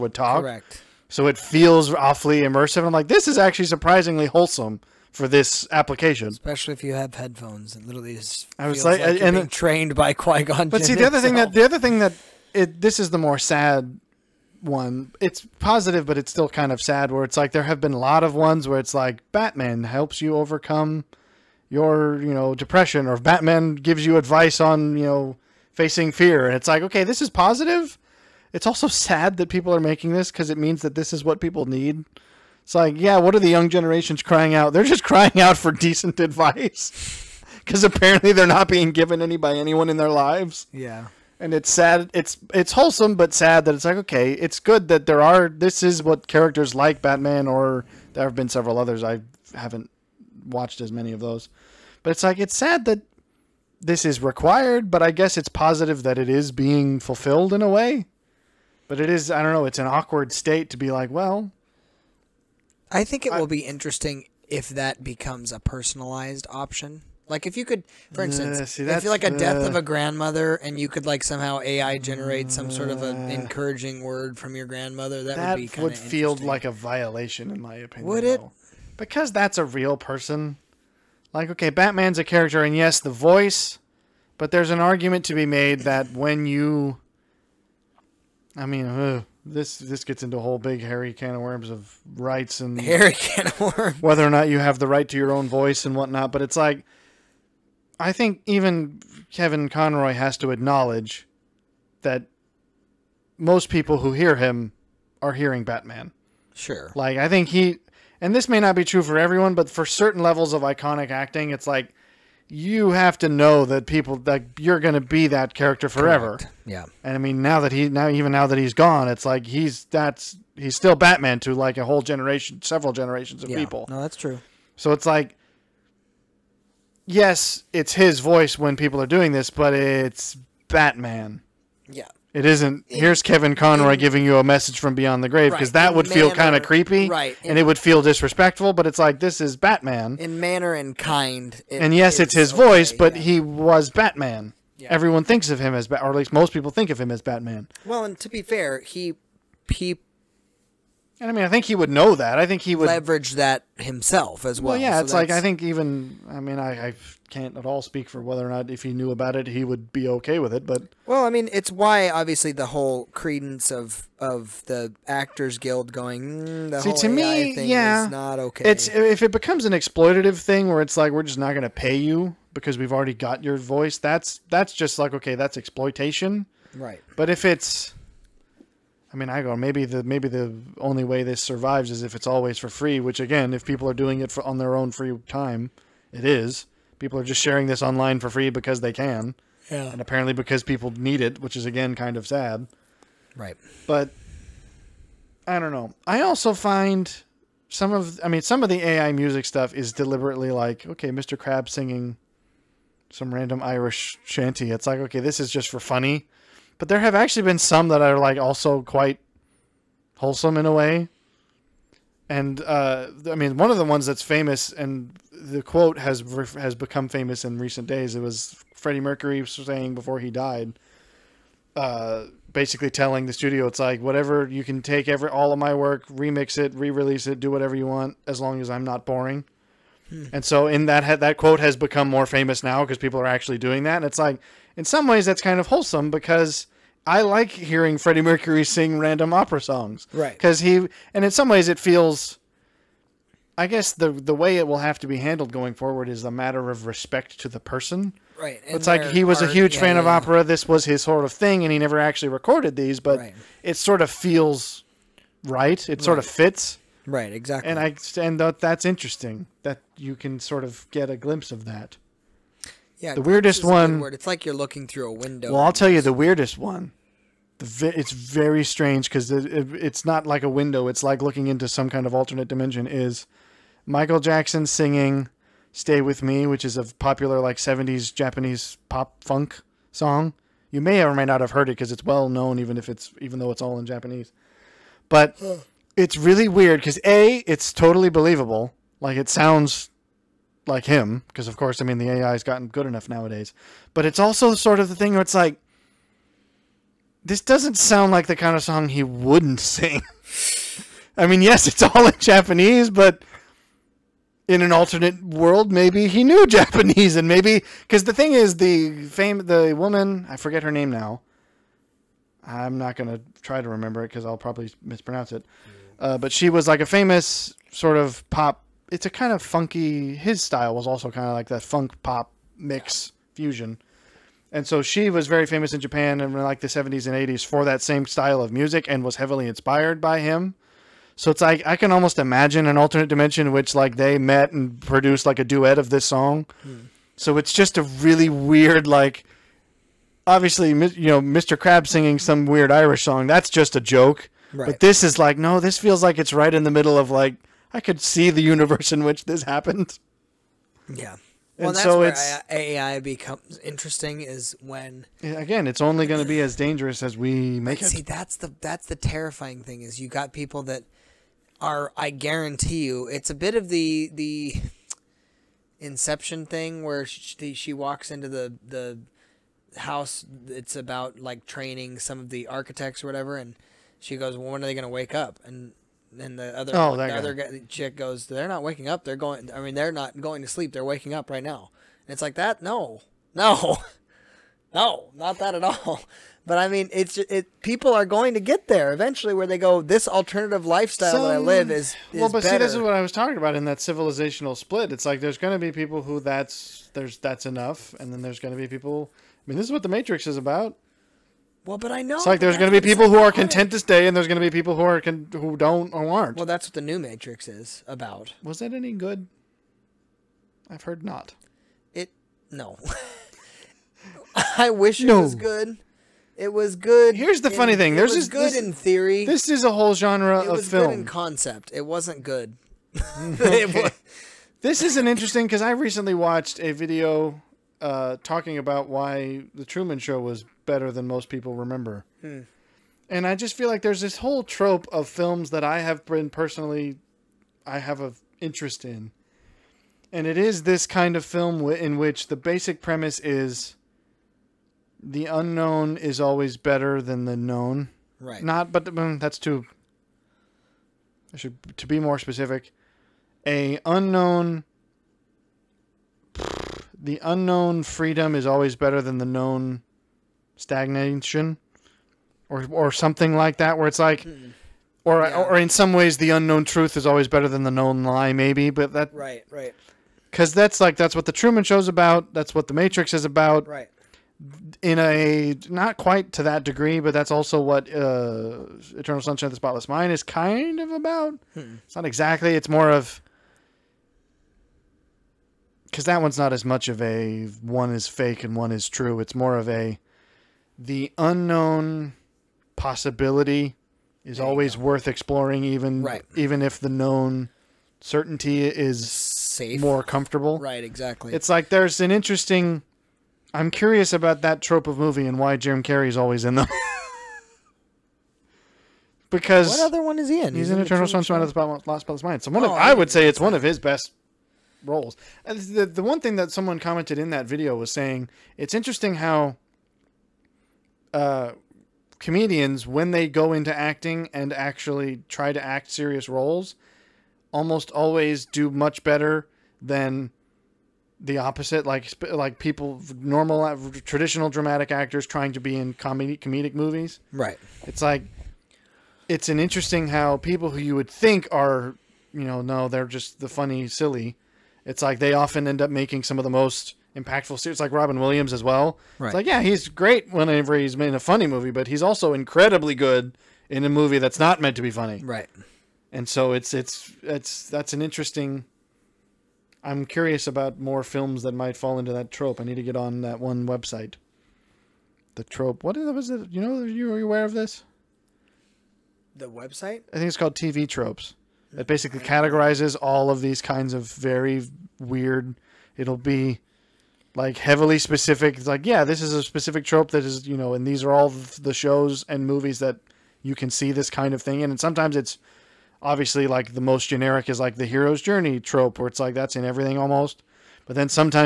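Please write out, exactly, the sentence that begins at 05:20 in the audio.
His style was also kind of like that funk pop mix fusion.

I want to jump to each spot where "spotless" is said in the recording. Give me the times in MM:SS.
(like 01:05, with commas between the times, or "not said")
07:59, 08:31.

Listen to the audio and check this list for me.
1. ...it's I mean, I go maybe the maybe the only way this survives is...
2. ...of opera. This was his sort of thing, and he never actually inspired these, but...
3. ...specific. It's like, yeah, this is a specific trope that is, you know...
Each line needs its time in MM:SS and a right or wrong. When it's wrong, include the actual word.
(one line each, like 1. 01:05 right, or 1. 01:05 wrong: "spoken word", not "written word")
1. 02:57 right
2. 04:09 wrong: "recorded", not "inspired"
3. 09:37 right.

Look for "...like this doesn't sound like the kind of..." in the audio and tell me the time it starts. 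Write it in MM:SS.
04:55.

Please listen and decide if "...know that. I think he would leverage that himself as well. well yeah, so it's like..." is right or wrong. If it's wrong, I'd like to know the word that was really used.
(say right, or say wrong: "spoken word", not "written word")
right.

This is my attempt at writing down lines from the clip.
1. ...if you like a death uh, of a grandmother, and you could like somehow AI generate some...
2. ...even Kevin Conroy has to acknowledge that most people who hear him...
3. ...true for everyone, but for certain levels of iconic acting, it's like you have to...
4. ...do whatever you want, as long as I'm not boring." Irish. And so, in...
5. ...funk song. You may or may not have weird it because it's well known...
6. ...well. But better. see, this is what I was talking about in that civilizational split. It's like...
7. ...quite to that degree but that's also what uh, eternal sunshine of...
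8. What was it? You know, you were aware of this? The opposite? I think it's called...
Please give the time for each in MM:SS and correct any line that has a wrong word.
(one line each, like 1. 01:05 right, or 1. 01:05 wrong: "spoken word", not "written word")
1. 01:08 right
2. 01:38 right
3. 01:48 right
4. 03:47 wrong: "Hmm", not "Irish"
5. 04:39 wrong: "heard", not "weird"
6. 06:32 right
7. 07:55 right
8. 09:25 wrong: "website", not "opposite".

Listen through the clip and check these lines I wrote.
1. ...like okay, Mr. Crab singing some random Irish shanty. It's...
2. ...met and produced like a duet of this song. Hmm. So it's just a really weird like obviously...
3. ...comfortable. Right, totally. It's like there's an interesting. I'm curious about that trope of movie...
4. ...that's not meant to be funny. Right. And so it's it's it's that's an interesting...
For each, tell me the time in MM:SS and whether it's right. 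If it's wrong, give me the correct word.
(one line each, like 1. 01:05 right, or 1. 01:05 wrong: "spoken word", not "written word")
1. 03:20 right
2. 05:34 right
3. 08:20 wrong: "exactly", not "totally"
4. 09:14 right.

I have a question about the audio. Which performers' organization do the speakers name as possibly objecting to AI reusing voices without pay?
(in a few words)
Actors Guild.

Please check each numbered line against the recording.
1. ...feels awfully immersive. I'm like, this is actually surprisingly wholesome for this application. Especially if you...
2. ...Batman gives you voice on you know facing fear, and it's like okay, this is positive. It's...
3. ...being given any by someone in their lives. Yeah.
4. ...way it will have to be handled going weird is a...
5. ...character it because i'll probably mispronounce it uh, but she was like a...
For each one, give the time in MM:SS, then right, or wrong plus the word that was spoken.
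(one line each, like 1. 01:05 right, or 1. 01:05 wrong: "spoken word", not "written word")
1. 00:01 right
2. 00:23 wrong: "advice", not "voice"
3. 00:38 wrong: "anyone", not "someone"
4. 04:04 wrong: "forward", not "weird"
5. 05:13 wrong: "remember", not "character".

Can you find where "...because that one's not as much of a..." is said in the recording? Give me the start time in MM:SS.
08:05.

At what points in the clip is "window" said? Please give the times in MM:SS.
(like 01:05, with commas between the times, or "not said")
04:25, 04:30.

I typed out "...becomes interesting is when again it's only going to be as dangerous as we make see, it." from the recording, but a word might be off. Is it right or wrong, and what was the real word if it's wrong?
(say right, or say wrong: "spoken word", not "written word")
right.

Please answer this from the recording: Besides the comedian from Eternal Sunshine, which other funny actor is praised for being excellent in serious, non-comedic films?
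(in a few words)
Robin Williams.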